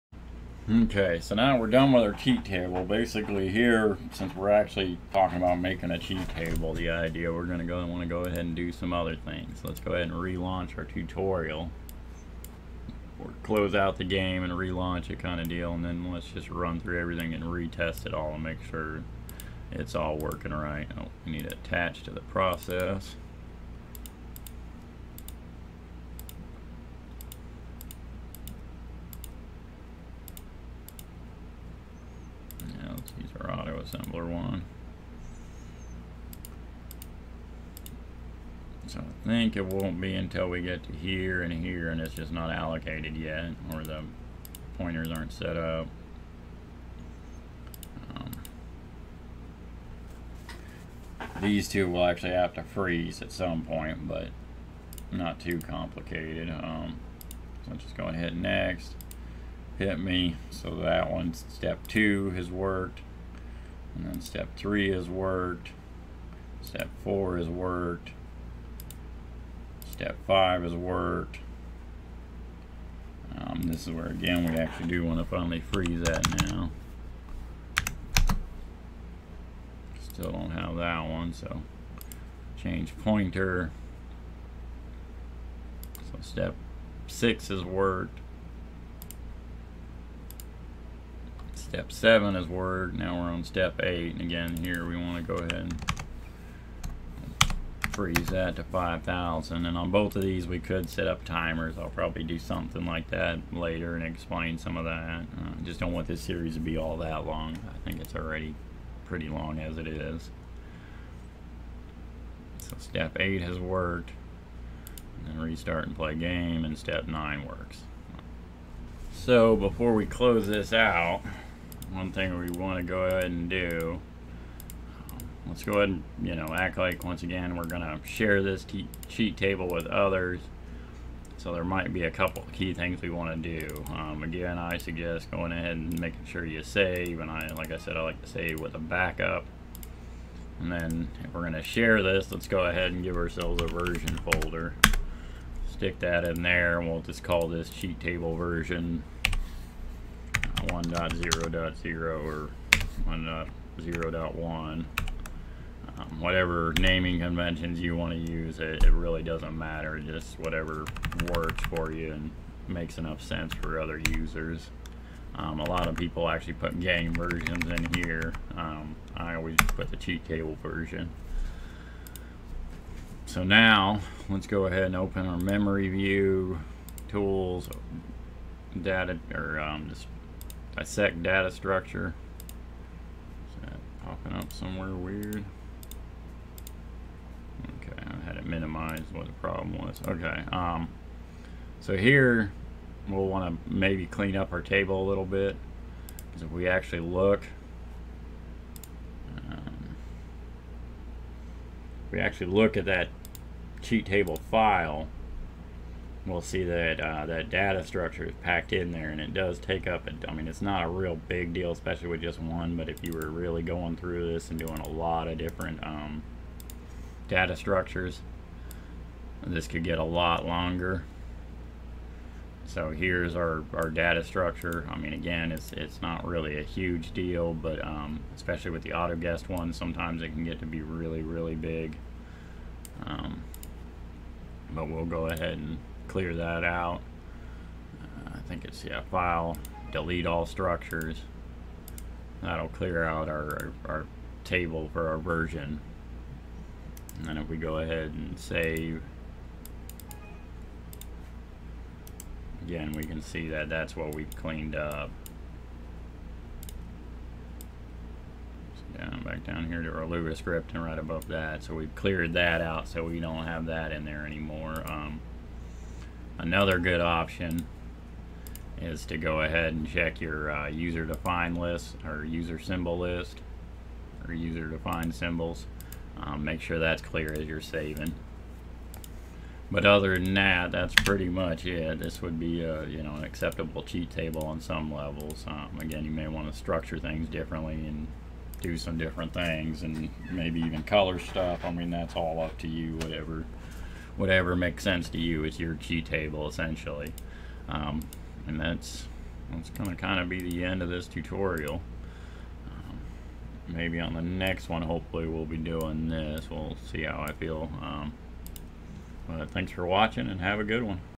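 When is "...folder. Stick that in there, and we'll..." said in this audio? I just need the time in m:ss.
2:24.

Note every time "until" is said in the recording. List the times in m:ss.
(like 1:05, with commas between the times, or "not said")
0:40.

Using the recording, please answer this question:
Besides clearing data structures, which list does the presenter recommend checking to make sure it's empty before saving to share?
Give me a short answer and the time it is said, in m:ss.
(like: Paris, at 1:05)
user defined symbols, at 4:34.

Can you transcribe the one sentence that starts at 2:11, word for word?
So there might be a couple key things we want to do.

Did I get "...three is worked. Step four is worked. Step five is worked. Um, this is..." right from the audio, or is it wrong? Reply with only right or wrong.
right.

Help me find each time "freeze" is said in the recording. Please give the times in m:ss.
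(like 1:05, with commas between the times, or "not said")
0:52, 1:15, 1:37.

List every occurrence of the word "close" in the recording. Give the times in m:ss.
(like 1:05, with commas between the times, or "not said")
0:13, 2:00.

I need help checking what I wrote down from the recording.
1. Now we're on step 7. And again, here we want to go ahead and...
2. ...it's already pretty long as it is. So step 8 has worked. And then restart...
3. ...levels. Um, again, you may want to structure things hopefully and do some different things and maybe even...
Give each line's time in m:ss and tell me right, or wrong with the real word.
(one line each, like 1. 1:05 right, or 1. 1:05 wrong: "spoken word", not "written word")
1. 1:32 wrong: "8", not "7"
2. 1:48 right
3. 4:44 wrong: "differently", not "hopefully".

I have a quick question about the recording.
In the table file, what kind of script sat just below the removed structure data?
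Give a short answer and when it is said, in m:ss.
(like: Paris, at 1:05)
Lua script, at 4:20.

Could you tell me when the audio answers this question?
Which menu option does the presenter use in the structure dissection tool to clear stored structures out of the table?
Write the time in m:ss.
3:59.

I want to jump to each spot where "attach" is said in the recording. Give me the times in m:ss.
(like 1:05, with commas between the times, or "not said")
0:21.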